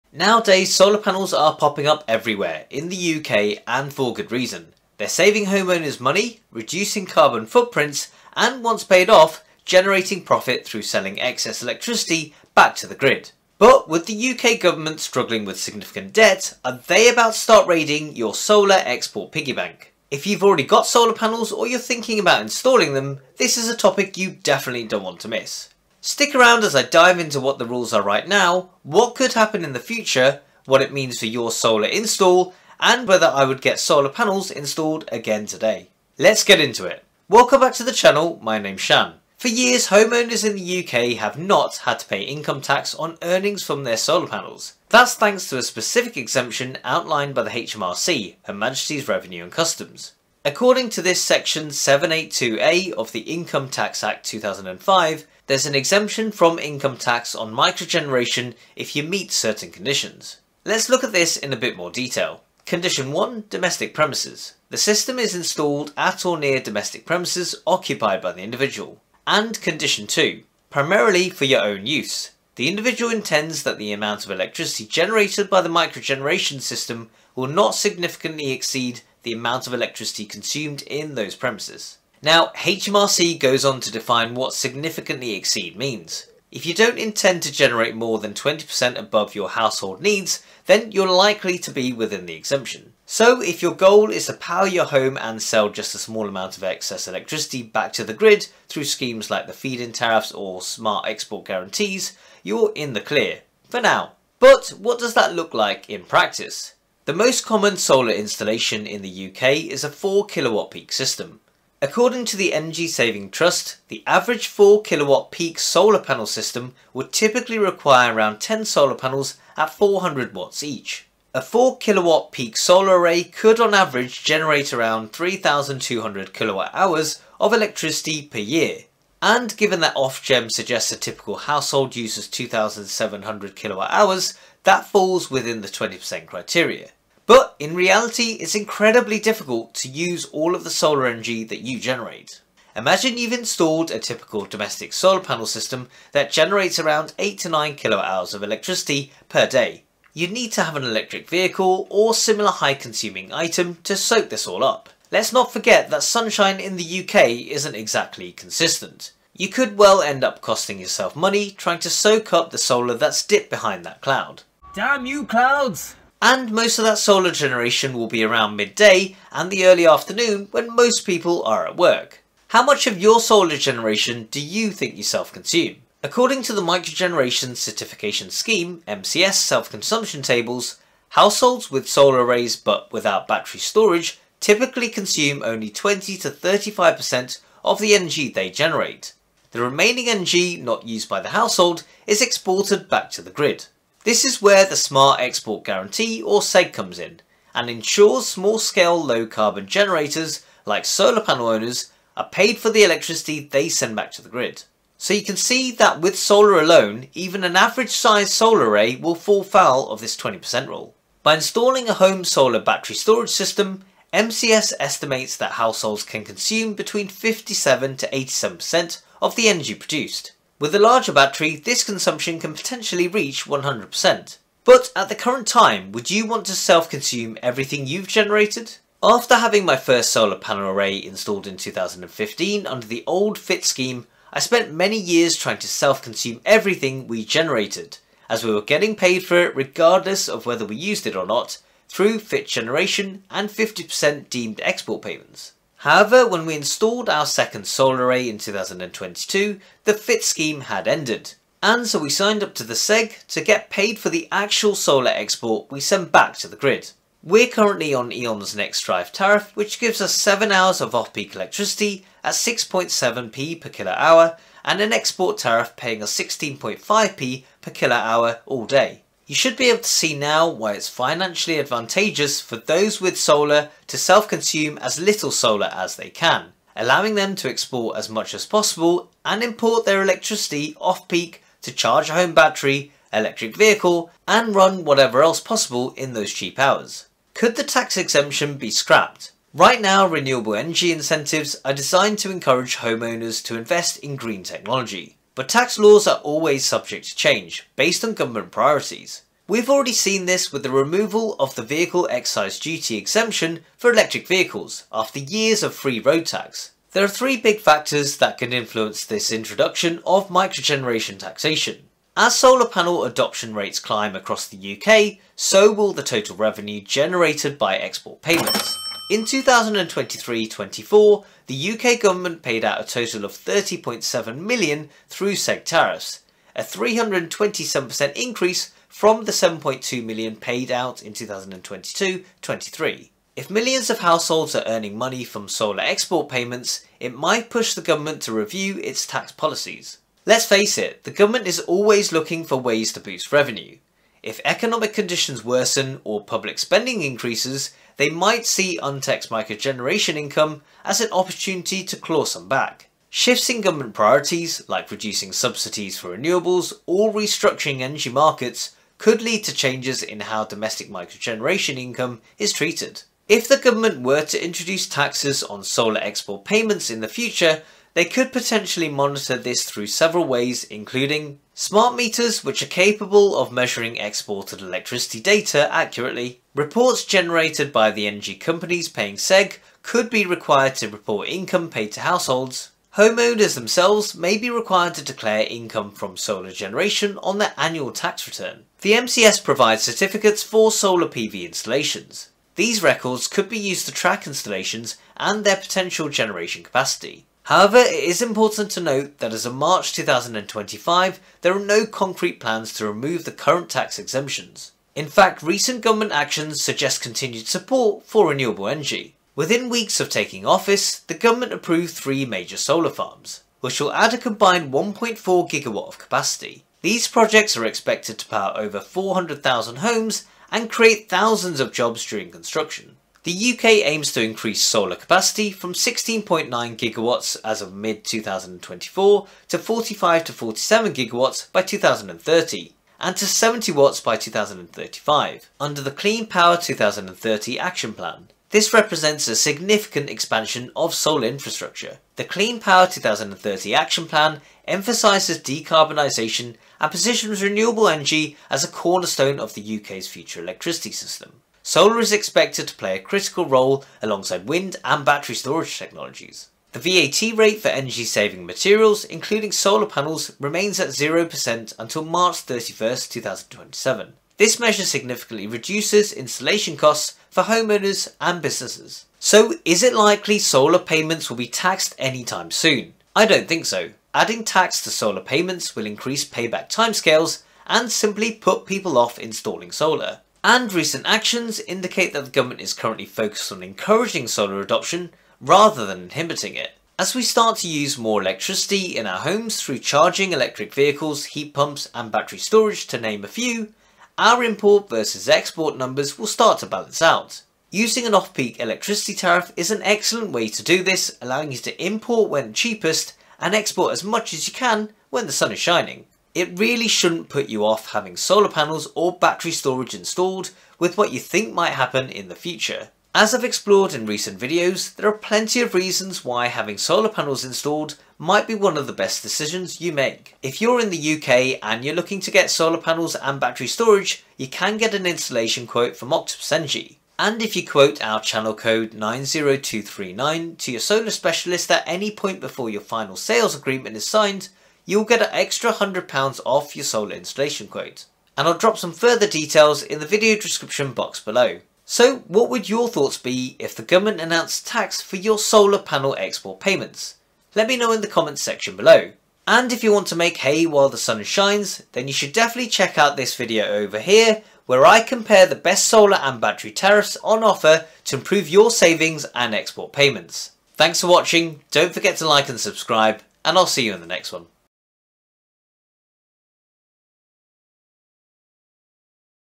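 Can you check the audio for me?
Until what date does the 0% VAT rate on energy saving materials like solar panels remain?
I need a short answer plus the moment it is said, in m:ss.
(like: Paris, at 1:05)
March 31, 2027, at 7:42.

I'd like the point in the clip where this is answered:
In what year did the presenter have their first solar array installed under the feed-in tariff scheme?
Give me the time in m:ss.
3:51.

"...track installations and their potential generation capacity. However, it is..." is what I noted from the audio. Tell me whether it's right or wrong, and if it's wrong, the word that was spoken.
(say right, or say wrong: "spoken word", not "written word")
right.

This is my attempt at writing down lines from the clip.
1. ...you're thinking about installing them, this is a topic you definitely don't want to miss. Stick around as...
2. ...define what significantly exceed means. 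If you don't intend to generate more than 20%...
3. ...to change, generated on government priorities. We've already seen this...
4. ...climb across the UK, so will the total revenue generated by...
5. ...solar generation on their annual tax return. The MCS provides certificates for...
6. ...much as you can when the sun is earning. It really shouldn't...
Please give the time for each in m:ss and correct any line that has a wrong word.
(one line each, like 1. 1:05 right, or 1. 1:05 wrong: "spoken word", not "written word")
1. 0:21 right
2. 1:23 right
3. 4:57 wrong: "based", not "generated"
4. 5:13 right
5. 6:26 right
6. 8:24 wrong: "shining", not "earning".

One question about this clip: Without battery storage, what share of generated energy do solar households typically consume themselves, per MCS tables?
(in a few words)
20 to 35%.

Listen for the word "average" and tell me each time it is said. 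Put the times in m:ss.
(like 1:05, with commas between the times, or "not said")
1:54, 2:03, 3:27.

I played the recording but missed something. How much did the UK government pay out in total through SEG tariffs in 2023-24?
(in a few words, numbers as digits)
30.7 million.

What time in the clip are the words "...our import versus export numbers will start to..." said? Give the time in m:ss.
8:14.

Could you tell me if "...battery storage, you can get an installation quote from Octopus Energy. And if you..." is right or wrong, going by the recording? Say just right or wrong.
right.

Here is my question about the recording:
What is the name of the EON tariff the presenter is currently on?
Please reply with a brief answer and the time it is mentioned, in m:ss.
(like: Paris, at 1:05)
Next Drive, at 4:18.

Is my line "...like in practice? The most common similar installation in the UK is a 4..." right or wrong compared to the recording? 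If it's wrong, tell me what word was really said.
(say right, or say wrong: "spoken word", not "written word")
wrong: "solar", not "similar".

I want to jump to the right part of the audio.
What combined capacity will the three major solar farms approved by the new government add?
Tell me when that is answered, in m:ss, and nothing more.
6:54.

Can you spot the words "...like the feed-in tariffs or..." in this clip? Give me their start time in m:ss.
1:39.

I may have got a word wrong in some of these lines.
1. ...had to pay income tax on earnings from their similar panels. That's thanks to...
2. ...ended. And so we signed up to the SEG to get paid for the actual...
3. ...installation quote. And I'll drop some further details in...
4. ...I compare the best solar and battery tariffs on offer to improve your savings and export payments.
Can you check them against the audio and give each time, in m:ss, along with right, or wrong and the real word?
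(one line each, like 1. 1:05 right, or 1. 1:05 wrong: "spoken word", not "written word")
1. 0:41 wrong: "solar", not "similar"
2. 4:10 right
3. 8:57 right
4. 9:14 right.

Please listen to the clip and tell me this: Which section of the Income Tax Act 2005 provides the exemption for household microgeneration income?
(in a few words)
782A.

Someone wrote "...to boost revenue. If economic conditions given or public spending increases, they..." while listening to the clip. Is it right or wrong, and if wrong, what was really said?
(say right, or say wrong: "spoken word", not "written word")
wrong: "worsen", not "given".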